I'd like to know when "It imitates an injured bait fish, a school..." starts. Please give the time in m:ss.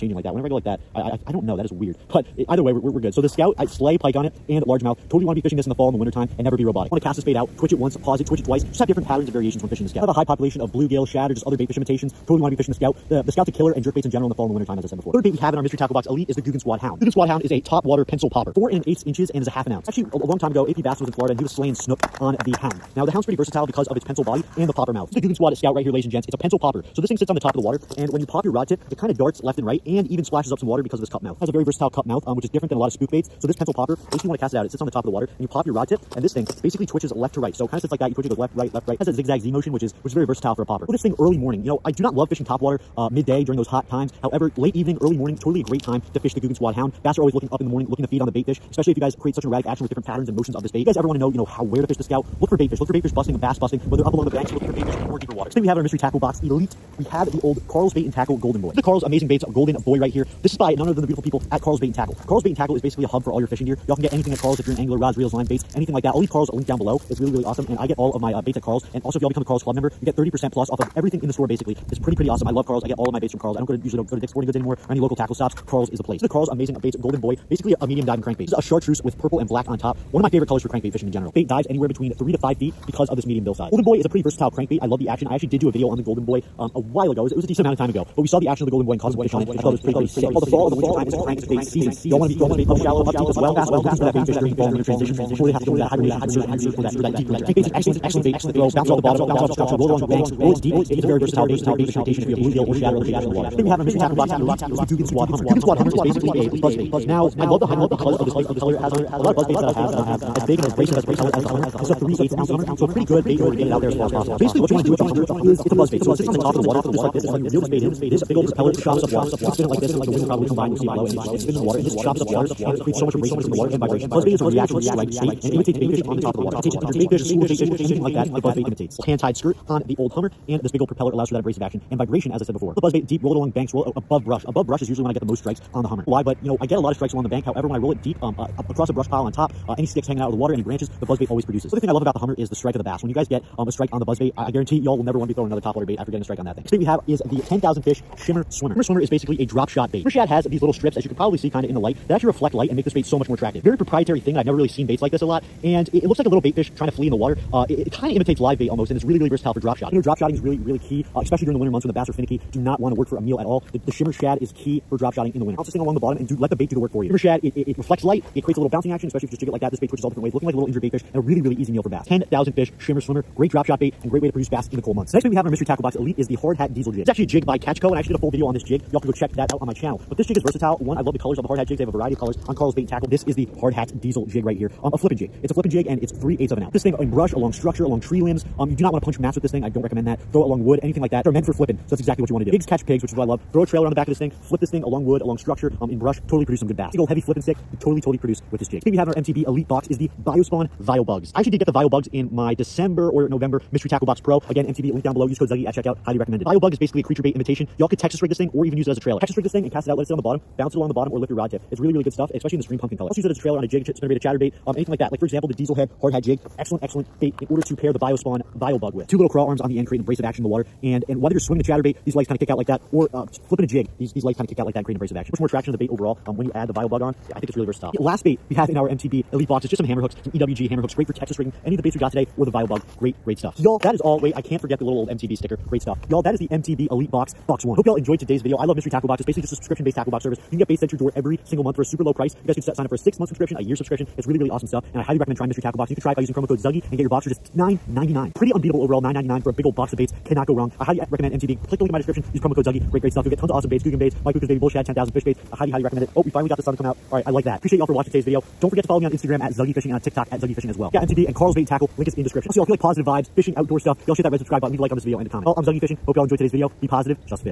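2:06.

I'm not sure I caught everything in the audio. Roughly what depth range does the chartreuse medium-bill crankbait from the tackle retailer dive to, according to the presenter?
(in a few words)
3 to 5 feet.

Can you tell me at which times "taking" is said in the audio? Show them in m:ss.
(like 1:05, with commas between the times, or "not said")
not said.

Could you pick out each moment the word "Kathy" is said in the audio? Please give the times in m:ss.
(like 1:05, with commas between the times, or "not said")
not said.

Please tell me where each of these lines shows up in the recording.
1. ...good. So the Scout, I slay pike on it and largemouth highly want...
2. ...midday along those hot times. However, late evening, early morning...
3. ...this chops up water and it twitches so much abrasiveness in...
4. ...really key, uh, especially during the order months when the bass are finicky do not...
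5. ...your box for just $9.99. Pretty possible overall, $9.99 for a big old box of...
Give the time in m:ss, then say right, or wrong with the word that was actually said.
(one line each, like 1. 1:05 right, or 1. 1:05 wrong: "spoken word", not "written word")
1. 0:02 wrong: "totally", not "highly"
2. 0:43 wrong: "during", not "along"
3. 2:01 wrong: "creates", not "twitches"
4. 2:40 wrong: "winter", not "order"
5. 4:07 wrong: "unbeatable", not "possible".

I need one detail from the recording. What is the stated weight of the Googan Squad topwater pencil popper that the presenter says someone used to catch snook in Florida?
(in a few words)
half an ounce.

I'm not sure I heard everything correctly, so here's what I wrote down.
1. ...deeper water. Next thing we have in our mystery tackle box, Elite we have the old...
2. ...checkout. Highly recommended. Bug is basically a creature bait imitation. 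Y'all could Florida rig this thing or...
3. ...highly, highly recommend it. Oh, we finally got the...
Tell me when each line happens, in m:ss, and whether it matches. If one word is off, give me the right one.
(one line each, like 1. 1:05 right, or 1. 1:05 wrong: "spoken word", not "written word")
1. 0:55 right
2. 3:25 wrong: "Texas", not "Florida"
3. 4:15 right.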